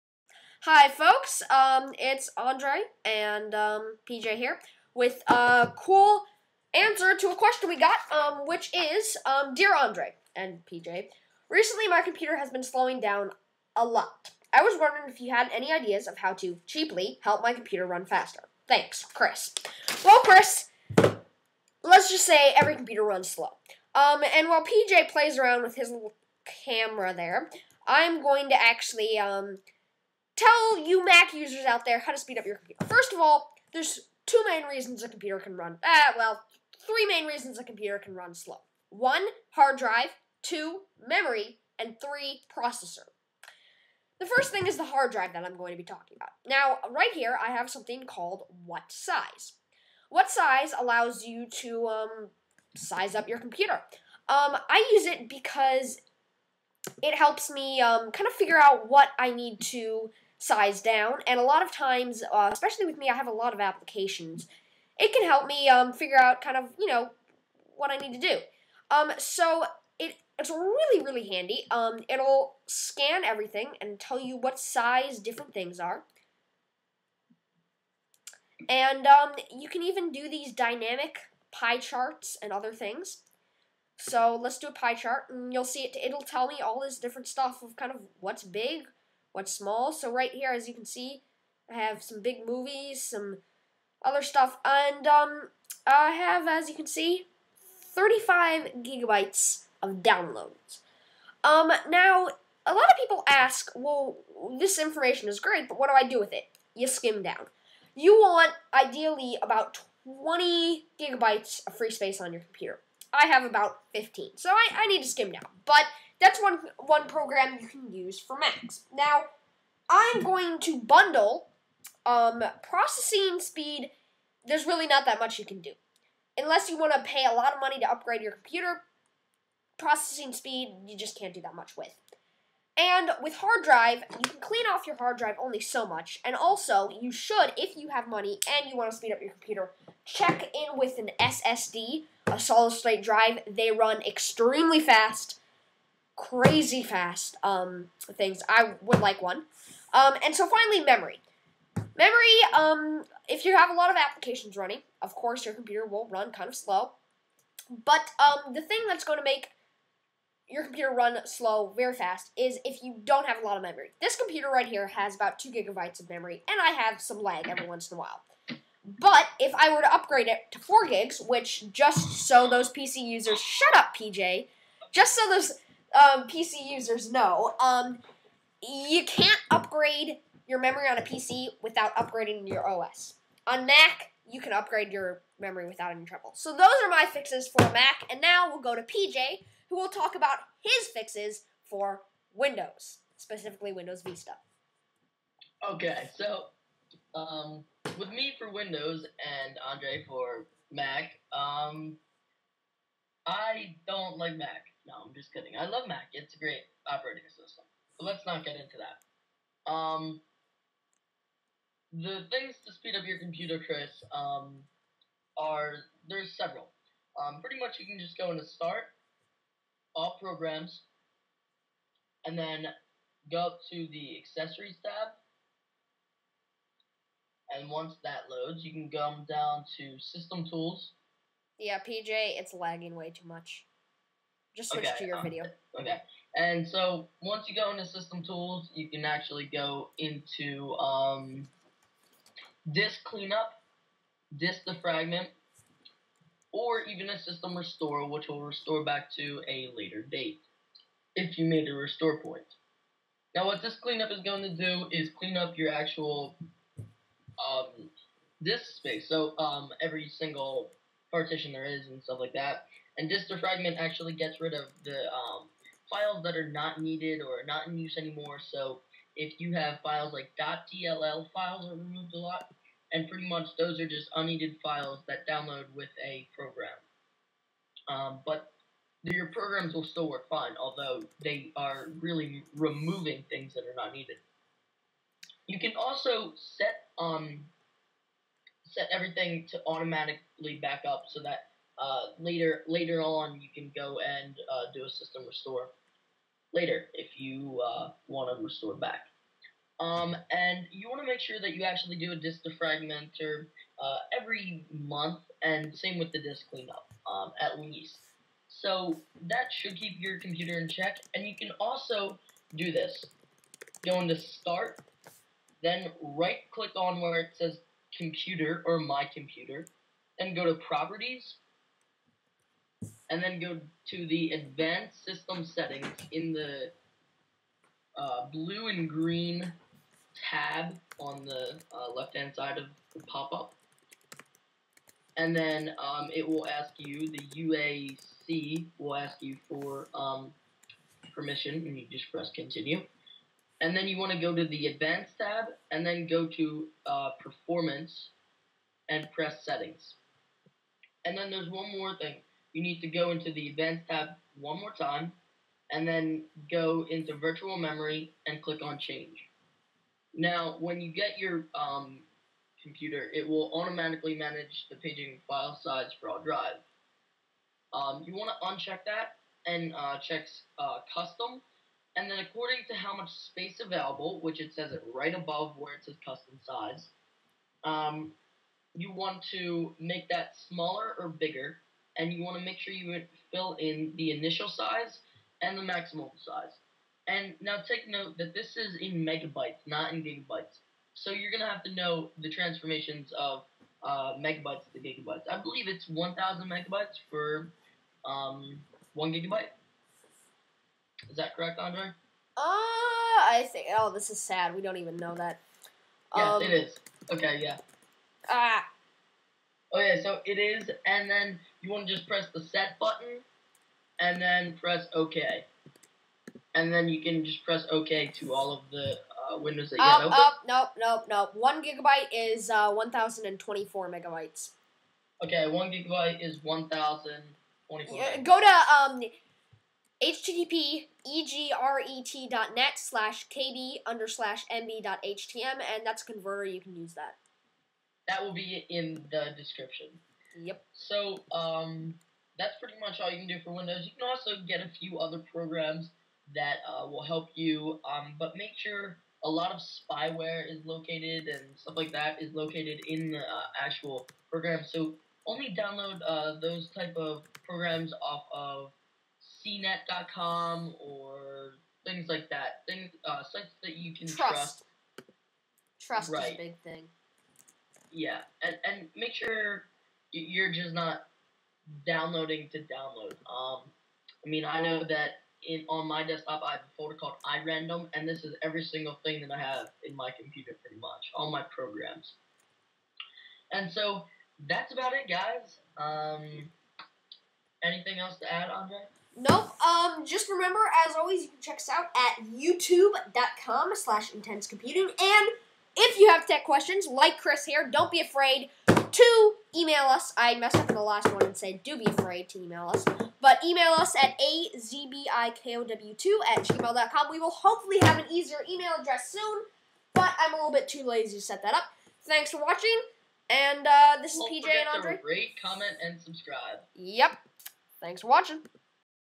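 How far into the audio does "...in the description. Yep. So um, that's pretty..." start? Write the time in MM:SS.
07:18.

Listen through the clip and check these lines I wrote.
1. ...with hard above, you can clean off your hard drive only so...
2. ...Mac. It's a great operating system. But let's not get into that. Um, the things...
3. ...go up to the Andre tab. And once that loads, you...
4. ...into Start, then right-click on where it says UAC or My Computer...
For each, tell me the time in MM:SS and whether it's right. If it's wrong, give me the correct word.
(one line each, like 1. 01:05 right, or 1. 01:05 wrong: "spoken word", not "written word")
1. 02:13 wrong: "drive", not "above"
2. 03:25 right
3. 03:43 wrong: "Accessories", not "Andre"
4. 05:14 wrong: "Computer", not "UAC".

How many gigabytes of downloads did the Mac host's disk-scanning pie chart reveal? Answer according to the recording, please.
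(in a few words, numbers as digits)
35.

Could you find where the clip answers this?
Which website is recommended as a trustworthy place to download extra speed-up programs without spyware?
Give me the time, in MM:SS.
07:39.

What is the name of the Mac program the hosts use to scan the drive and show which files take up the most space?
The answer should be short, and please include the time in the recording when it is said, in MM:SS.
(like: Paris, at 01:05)
WhatSize, at 00:48.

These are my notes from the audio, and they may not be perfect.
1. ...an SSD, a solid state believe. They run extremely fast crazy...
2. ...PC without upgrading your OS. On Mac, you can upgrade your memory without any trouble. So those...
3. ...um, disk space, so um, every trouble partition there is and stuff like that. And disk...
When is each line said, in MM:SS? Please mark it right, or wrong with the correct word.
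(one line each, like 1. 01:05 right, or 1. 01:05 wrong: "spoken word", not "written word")
1. 02:20 wrong: "drive", not "believe"
2. 03:01 right
3. 04:16 wrong: "single", not "trouble".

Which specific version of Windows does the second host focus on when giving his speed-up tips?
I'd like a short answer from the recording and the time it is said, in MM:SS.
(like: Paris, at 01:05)
Windows Vista, at 03:13.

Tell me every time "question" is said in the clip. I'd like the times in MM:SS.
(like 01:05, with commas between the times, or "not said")
00:07, 08:16.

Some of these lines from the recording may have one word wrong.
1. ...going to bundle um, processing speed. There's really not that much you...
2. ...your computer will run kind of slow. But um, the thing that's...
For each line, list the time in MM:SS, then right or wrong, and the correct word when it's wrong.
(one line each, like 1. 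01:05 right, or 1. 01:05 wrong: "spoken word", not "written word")
1. 02:00 right
2. 02:35 right.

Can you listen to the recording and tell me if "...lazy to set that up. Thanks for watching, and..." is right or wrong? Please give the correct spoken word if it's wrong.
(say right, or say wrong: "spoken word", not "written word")
right.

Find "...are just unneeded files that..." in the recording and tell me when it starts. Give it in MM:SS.
04:33.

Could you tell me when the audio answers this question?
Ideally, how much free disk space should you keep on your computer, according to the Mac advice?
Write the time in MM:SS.
01:50.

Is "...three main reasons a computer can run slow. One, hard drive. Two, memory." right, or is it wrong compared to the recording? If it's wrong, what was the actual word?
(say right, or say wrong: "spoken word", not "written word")
right.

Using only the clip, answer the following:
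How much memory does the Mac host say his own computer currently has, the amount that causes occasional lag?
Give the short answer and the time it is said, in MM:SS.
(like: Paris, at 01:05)
2 gigabytes, at 02:45.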